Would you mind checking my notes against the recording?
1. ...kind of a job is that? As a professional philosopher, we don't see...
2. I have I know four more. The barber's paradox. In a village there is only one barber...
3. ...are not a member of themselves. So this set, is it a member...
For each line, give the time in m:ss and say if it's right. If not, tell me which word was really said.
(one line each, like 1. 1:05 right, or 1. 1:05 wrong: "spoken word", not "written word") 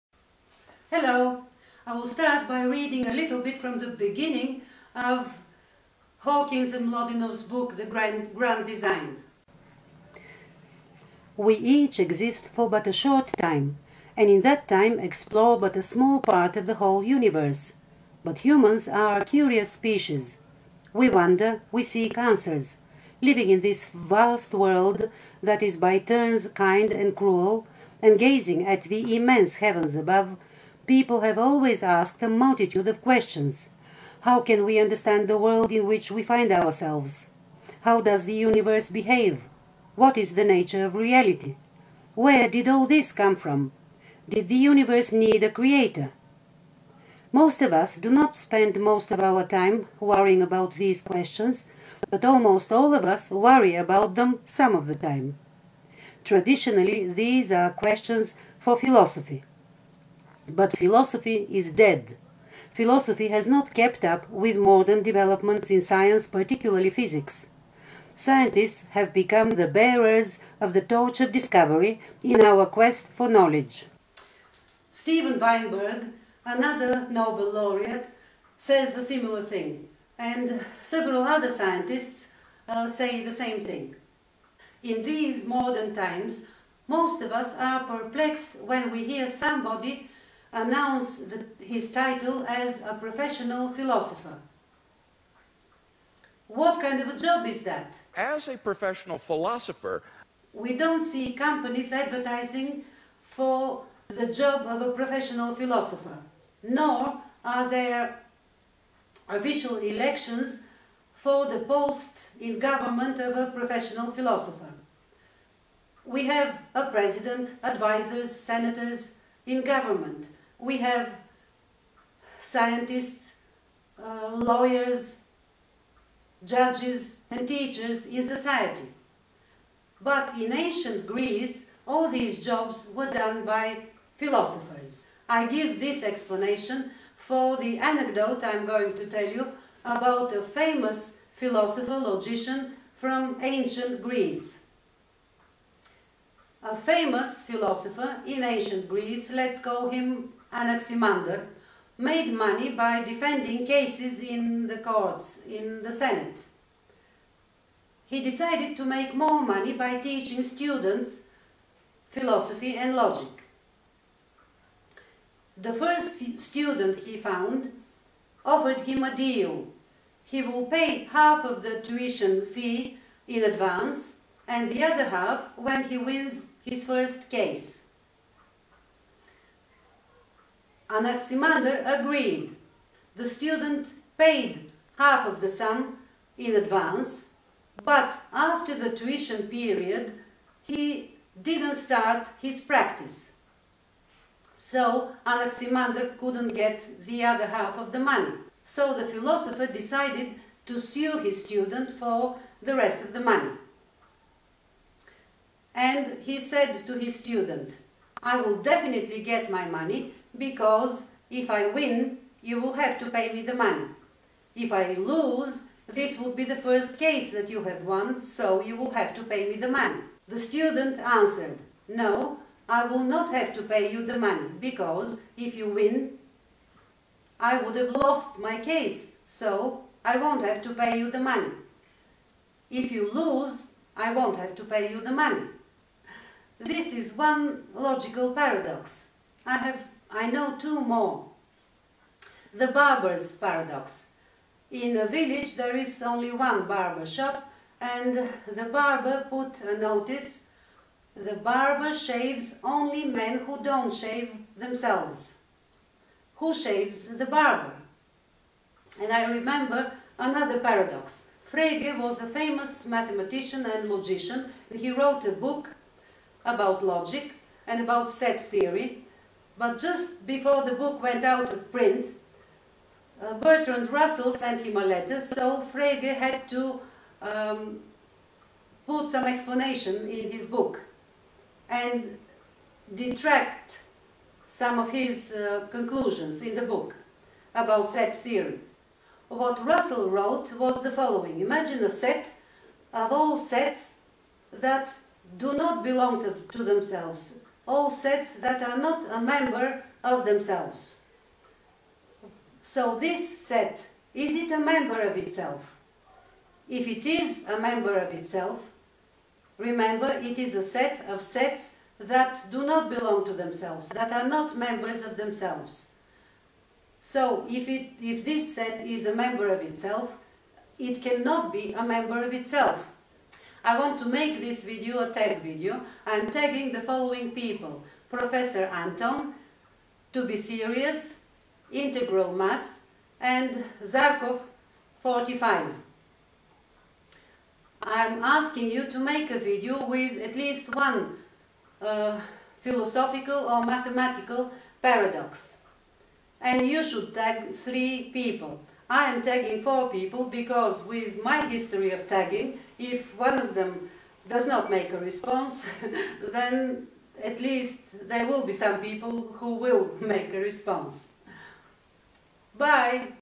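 1. 1:36 right
2. 3:59 wrong: "two", not "four"
3. 4:58 right.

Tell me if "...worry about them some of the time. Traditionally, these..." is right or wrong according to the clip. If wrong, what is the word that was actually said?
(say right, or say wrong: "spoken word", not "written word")
right.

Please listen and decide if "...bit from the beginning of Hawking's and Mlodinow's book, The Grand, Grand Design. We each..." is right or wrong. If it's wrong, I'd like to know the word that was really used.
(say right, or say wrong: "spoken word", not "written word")
right.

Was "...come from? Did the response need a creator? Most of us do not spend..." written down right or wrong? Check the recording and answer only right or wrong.
wrong.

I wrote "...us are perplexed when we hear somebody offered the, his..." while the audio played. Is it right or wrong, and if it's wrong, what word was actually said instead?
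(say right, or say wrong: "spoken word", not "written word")
wrong: "announced", not "offered".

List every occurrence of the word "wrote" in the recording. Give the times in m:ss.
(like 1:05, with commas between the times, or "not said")
4:24, 4:50.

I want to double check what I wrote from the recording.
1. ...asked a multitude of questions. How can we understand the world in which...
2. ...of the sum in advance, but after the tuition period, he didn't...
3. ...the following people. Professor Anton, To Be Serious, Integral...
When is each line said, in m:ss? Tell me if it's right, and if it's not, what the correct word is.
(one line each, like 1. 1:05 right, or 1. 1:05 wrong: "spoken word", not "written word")
1. 0:31 right
2. 3:05 right
3. 5:26 right.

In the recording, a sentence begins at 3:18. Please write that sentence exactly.
So the philosopher decided to sue his student for the rest of the money.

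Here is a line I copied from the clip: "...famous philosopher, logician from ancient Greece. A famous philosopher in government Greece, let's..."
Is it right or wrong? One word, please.
wrong.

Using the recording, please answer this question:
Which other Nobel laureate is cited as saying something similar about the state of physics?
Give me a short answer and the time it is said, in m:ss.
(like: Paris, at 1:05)
Steven Weinberg, at 1:14.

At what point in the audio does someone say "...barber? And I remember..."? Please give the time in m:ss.
4:17.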